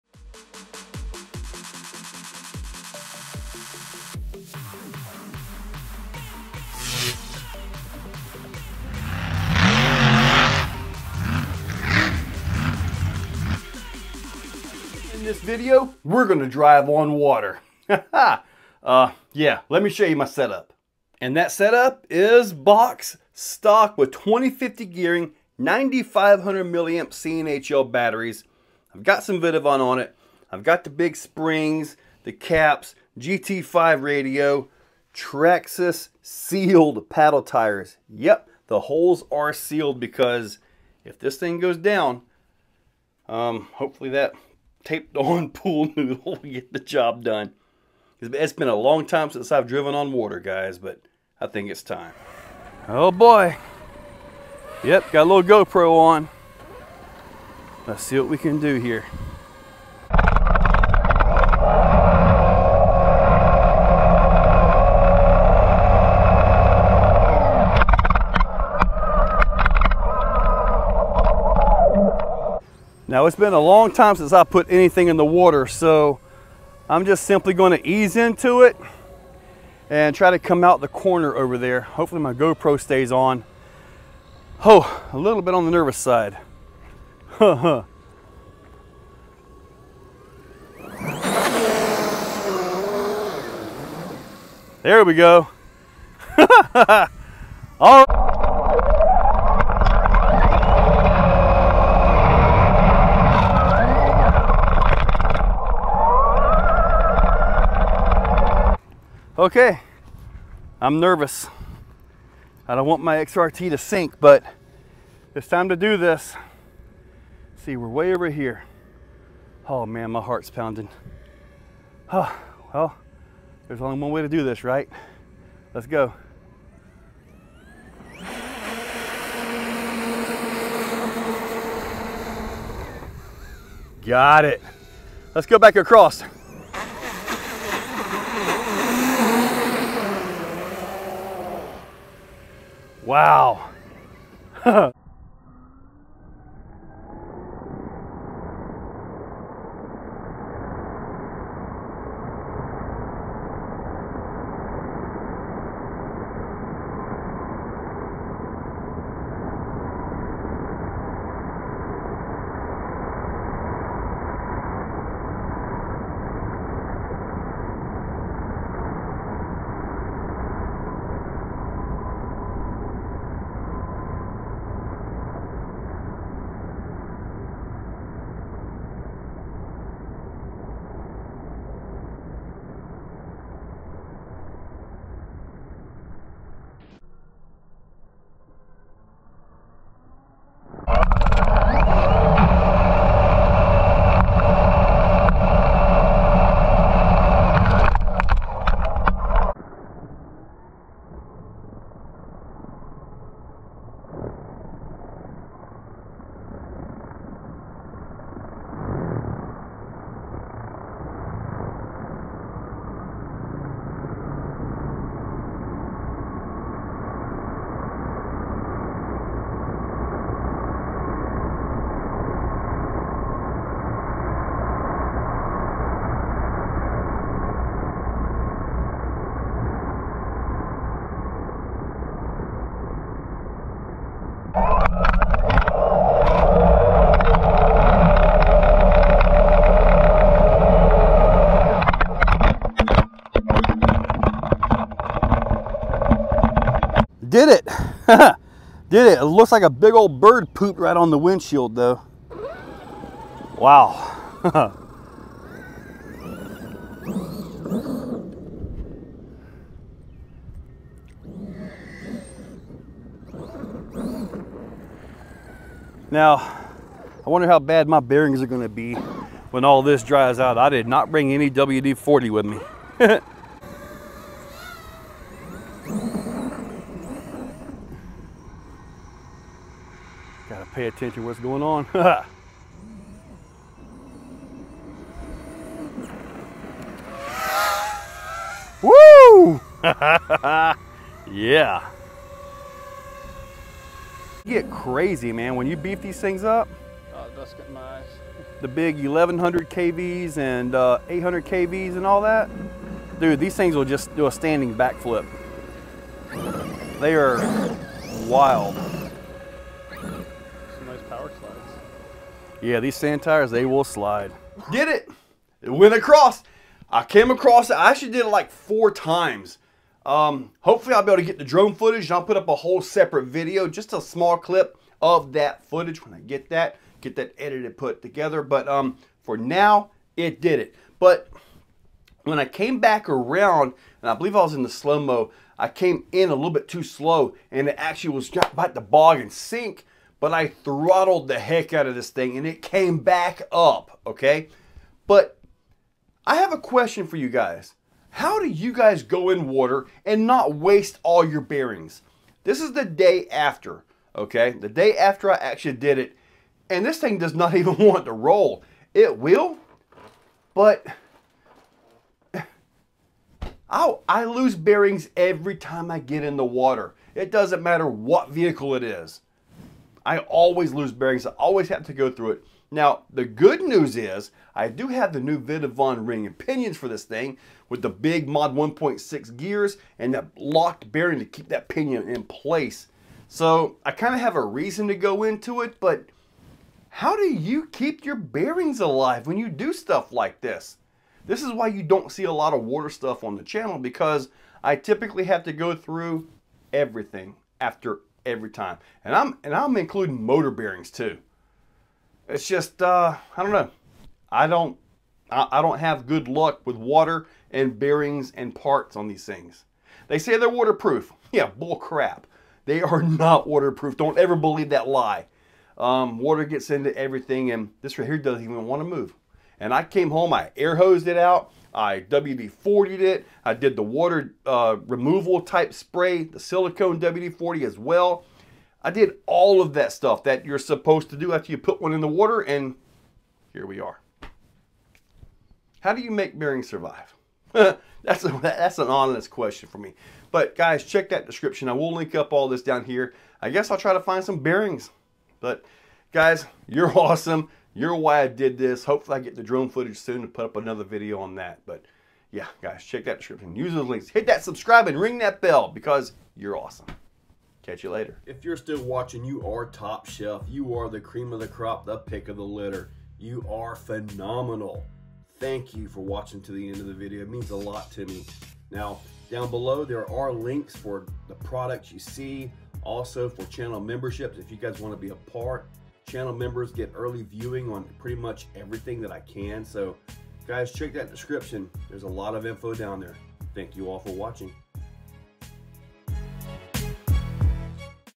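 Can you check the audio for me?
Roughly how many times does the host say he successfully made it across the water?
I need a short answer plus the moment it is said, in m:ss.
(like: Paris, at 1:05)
4, at 5:18.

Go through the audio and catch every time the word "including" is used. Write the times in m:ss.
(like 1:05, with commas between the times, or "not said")
6:39.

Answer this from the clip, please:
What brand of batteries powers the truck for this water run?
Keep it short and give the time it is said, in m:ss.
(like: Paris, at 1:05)
CNHL, at 0:27.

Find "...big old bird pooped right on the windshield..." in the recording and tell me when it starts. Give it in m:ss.
4:09.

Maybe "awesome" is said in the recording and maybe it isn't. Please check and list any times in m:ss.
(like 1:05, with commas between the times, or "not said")
7:26, 7:36.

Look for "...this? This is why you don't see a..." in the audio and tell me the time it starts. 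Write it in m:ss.
6:30.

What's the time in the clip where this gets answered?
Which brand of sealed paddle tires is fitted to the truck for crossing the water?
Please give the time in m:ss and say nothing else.
0:35.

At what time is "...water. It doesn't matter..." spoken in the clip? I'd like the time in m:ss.
6:06.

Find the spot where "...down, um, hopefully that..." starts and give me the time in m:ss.
0:41.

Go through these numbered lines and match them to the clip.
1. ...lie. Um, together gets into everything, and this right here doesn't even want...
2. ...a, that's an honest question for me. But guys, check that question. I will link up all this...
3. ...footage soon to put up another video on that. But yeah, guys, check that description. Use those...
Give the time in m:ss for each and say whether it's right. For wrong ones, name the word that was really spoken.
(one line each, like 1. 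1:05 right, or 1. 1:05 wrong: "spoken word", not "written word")
1. 6:54 wrong: "water", not "together"
2. 7:18 wrong: "description", not "question"
3. 7:29 right.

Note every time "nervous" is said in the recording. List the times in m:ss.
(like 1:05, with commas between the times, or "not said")
1:25, 1:50.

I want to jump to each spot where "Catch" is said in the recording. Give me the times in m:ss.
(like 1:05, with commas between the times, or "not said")
7:37.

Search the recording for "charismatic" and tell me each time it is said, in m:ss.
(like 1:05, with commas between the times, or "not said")
not said.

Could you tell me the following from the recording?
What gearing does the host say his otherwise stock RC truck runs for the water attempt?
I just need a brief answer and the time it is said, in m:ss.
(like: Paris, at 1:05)
2050, at 0:24.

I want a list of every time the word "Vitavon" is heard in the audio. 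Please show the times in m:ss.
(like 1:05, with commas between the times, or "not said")
0:29, 6:15.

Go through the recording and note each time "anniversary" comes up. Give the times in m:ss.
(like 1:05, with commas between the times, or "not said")
not said.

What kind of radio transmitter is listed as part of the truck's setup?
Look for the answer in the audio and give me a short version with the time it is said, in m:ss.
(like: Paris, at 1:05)
GT5, at 0:33.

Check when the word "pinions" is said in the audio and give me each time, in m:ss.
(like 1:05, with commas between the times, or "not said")
6:16, 6:21.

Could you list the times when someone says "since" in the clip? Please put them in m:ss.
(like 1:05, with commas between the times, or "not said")
0:49, 1:14.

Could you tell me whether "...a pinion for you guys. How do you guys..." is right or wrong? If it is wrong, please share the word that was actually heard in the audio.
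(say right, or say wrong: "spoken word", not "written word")
wrong: "question", not "pinion".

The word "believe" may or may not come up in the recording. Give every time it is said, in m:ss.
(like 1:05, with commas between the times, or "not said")
5:34, 6:54.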